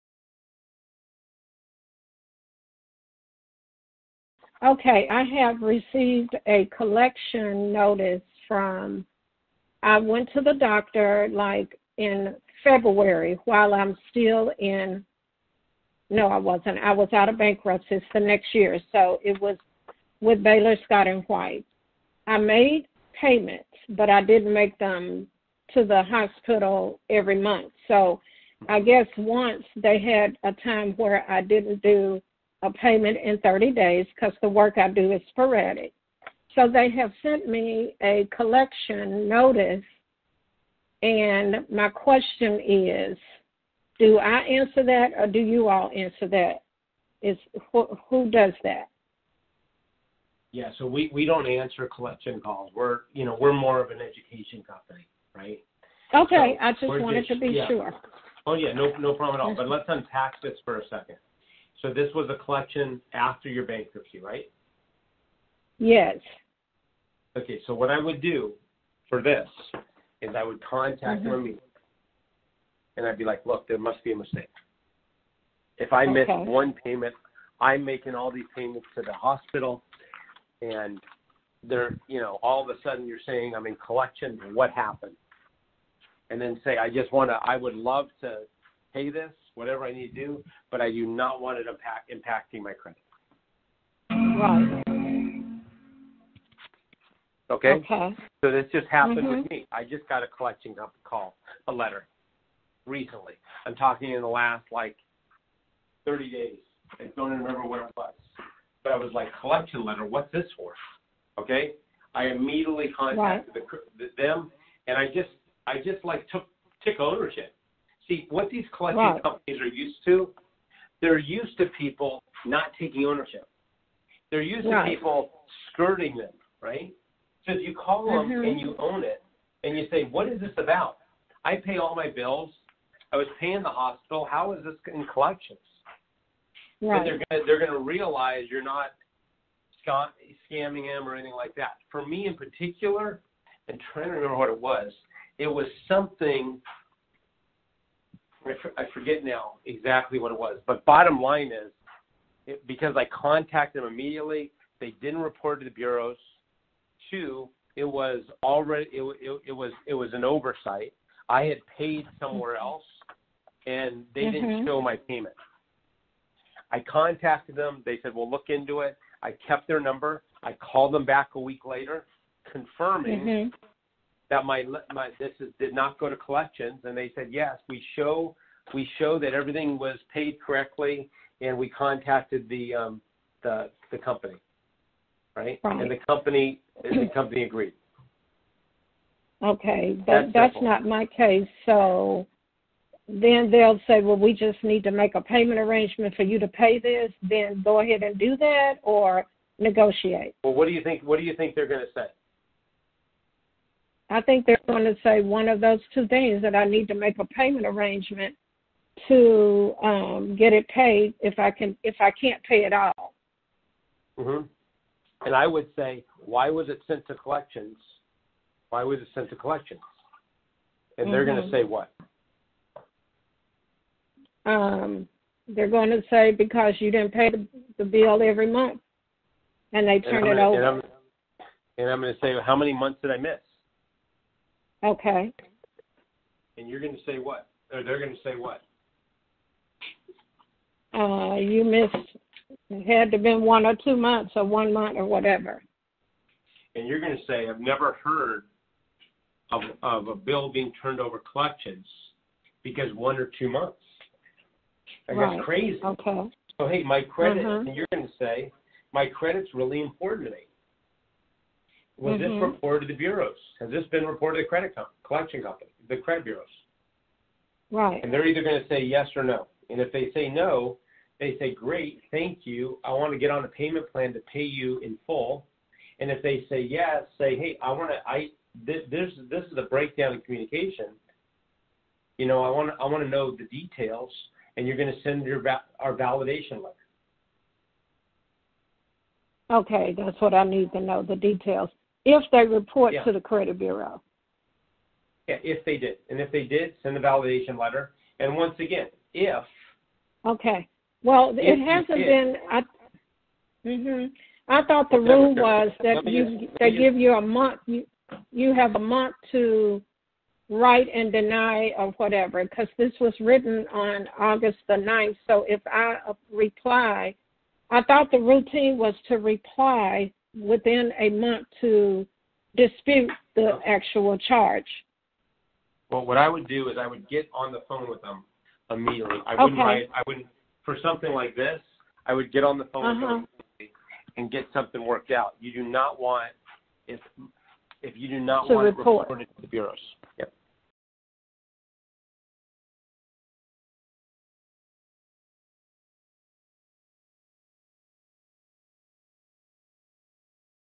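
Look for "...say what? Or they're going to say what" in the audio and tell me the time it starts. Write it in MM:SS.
03:57.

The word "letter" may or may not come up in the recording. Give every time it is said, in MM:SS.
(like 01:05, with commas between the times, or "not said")
01:41, 01:49, 04:46, 04:57.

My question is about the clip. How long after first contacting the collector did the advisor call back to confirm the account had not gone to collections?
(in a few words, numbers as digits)
A week.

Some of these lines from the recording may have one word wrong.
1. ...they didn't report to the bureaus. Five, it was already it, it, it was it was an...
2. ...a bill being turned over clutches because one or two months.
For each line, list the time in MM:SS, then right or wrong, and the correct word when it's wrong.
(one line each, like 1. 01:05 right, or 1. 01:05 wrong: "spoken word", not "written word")
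1. 02:34 wrong: "Two", not "Five"
2. 04:10 right.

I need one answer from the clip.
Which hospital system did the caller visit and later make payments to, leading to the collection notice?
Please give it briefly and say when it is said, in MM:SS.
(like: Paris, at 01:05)
Baylor Scott and White, at 00:20.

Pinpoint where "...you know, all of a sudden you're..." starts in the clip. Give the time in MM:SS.
01:22.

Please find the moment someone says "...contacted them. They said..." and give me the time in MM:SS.
02:46.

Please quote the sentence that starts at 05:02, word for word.
I, hmm I thought the rule was that you they give you a month.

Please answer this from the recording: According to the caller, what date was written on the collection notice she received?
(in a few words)
August 9th.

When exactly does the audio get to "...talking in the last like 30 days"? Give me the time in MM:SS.
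01:43.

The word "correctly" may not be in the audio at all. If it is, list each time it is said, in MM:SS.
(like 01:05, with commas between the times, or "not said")
03:00.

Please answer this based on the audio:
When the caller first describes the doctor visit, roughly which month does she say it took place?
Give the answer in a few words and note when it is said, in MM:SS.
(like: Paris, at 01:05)
February, at 00:12.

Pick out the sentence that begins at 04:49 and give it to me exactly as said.
Okay, that's what I need to know the details if they report yeah.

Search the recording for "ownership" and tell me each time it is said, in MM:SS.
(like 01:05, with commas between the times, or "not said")
01:56, 02:03.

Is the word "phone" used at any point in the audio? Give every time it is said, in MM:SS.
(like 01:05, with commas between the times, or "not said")
05:27, 05:32.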